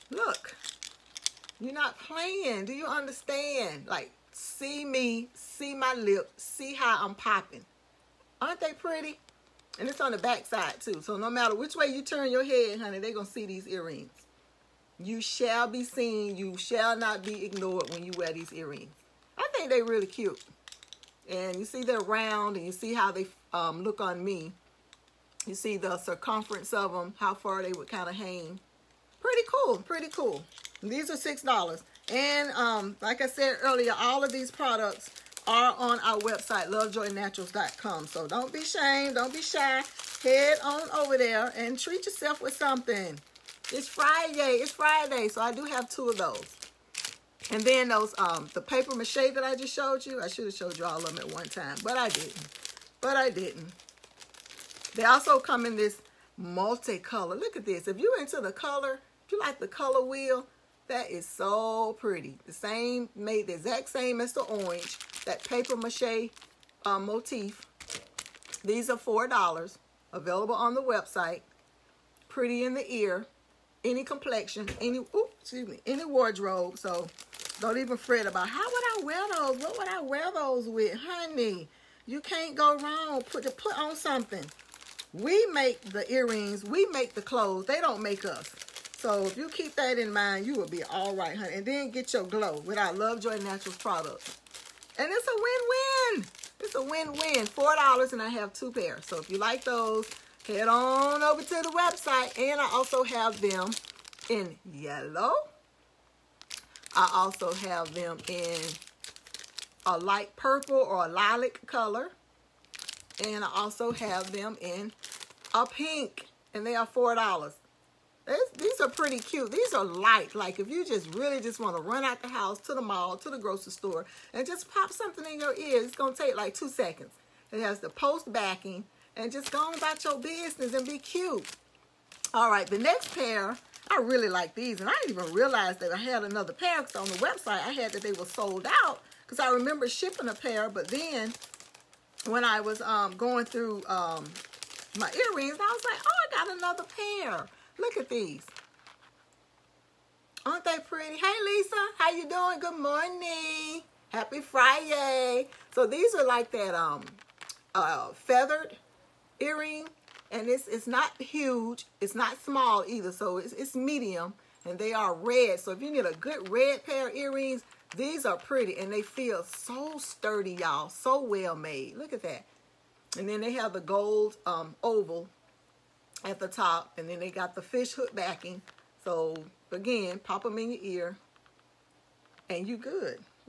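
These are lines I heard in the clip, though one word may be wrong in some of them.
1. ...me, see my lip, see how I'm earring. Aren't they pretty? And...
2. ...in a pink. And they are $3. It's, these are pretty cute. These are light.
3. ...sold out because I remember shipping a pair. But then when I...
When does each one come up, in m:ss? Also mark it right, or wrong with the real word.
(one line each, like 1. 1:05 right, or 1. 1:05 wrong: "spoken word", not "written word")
1. 0:04 wrong: "popping", not "earring"
2. 1:54 wrong: "4", not "3"
3. 2:18 right.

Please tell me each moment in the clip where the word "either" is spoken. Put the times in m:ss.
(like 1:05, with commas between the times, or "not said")
2:42.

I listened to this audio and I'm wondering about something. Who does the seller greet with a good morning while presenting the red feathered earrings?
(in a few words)
Lisa.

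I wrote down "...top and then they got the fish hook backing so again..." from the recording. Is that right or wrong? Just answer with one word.
right.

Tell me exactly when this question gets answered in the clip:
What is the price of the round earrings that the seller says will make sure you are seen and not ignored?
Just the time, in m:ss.
0:31.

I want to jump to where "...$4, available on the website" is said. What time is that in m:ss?
1:08.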